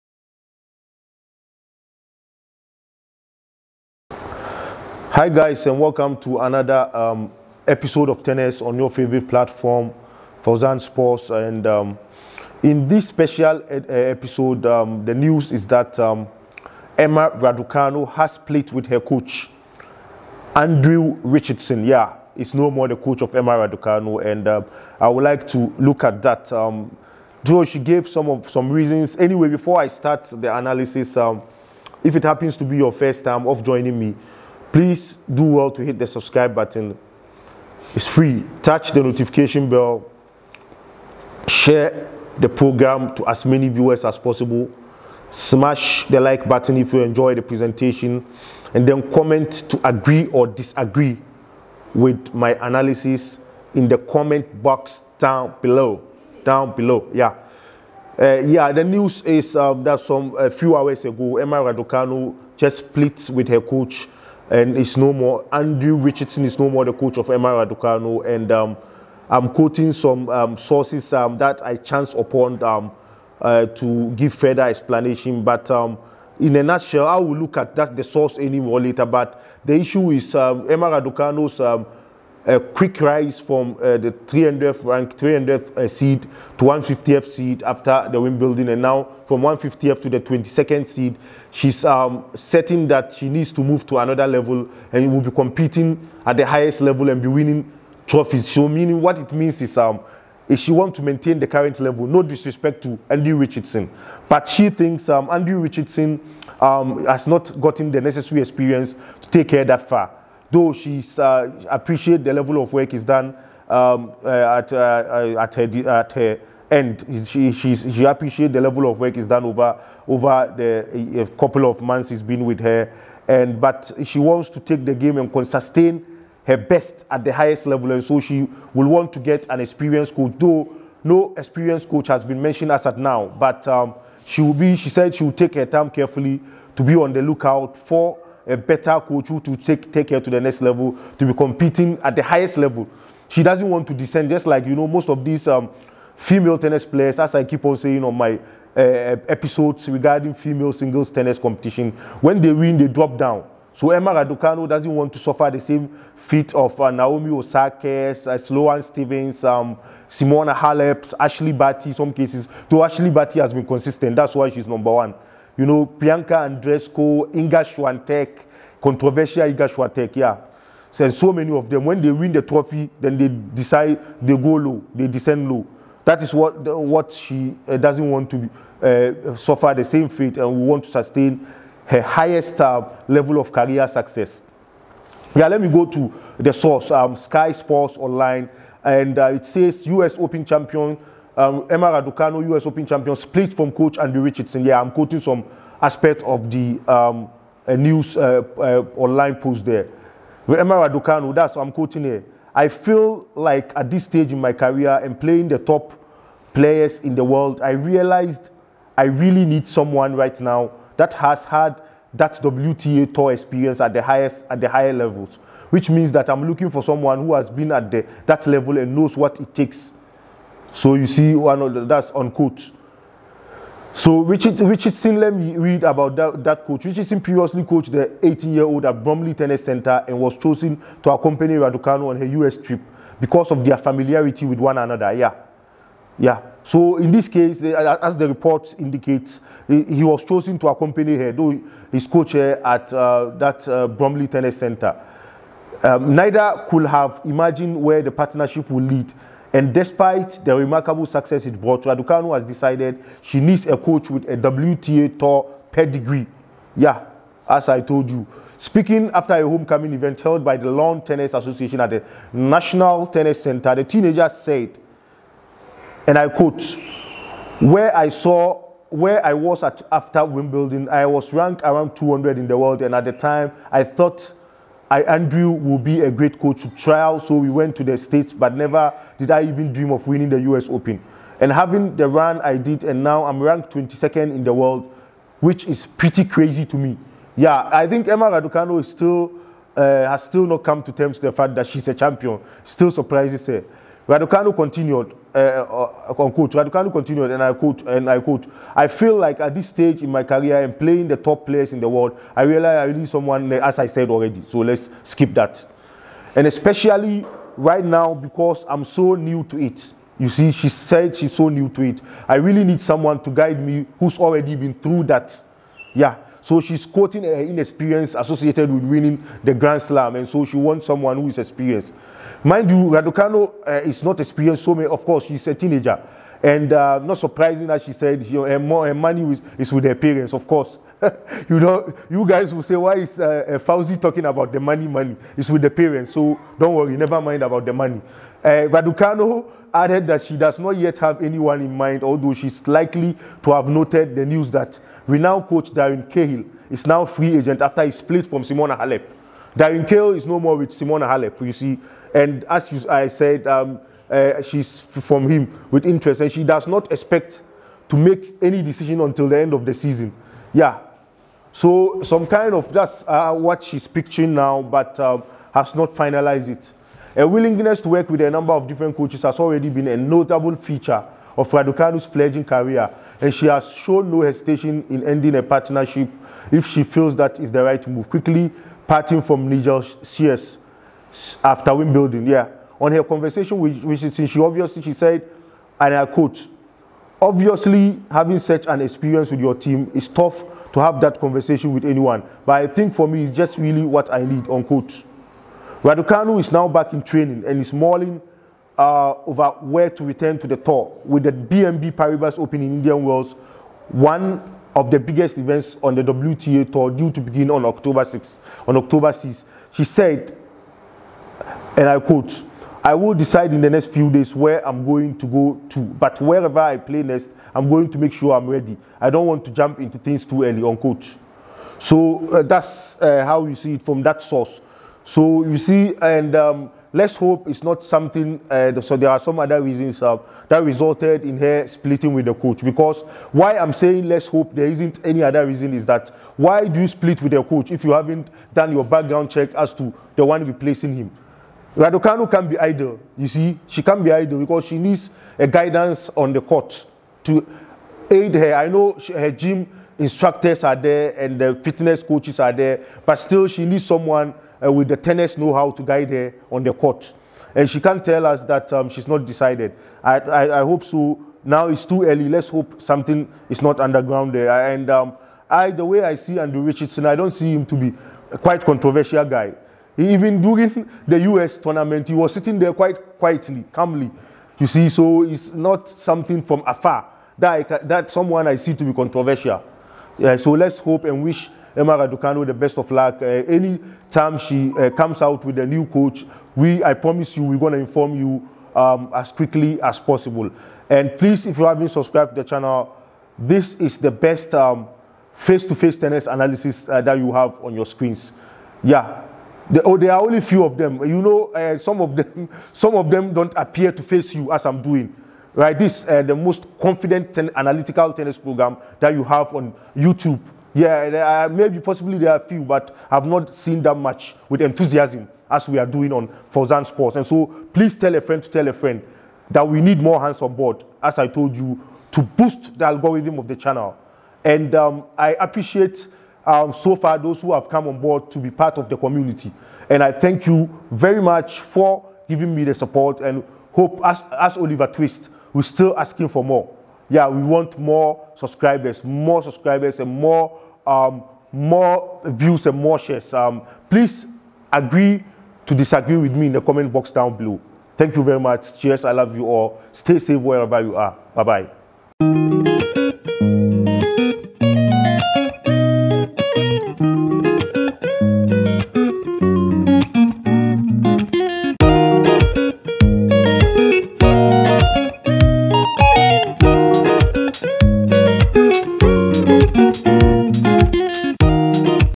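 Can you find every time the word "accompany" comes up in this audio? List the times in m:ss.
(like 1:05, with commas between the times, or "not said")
3:51, 4:00.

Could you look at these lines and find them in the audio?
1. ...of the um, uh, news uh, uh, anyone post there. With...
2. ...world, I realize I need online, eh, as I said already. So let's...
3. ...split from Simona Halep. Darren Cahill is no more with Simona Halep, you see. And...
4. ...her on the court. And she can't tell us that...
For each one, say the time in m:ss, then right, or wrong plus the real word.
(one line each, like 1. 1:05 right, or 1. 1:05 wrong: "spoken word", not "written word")
1. 3:16 wrong: "online", not "anyone"
2. 5:01 wrong: "someone", not "online"
3. 5:47 right
4. 7:36 right.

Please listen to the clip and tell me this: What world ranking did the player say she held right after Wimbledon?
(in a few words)
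200.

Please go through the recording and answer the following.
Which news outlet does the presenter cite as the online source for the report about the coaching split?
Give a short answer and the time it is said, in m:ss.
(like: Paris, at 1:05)
Sky Sports Online, at 3:07.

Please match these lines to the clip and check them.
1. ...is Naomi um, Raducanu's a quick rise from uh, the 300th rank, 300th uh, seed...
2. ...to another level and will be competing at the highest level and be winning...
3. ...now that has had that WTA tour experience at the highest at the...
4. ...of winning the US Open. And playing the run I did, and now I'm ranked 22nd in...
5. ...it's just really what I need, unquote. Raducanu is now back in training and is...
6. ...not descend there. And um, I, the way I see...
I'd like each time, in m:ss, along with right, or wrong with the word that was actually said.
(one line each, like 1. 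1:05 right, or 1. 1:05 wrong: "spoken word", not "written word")
1. 1:20 wrong: "Emma", not "Naomi"
2. 1:33 right
3. 3:30 right
4. 4:39 wrong: "having", not "playing"
5. 6:33 right
6. 7:43 wrong: "underground", not "descend".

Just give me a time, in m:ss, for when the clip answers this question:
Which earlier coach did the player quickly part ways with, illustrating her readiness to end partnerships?
6:19.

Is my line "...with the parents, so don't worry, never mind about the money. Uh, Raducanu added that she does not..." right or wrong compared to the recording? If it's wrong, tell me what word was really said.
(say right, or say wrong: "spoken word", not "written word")
right.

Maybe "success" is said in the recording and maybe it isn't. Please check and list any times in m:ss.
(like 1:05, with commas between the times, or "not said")
3:03, 4:11.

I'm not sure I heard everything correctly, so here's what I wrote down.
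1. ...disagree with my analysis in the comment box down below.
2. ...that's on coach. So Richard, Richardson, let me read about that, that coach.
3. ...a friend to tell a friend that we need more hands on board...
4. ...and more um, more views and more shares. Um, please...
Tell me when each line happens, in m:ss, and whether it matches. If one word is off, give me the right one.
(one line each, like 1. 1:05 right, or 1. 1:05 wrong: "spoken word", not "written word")
1. 0:50 right
2. 3:41 right
3. 8:38 right
4. 8:59 right.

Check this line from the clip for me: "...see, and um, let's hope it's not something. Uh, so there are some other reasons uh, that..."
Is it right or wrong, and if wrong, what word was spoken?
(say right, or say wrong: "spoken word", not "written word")
right.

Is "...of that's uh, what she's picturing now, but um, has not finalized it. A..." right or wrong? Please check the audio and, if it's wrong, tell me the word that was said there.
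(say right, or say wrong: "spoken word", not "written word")
right.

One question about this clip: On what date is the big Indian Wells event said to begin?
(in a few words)
October 6.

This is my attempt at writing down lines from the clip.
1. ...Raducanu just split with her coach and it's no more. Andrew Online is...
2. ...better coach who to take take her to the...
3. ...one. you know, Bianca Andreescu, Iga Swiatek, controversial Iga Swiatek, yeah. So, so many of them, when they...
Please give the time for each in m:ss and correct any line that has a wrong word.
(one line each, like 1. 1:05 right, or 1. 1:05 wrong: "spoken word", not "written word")
1. 1:01 wrong: "Richardson", not "Online"
2. 2:18 right
3. 2:44 right.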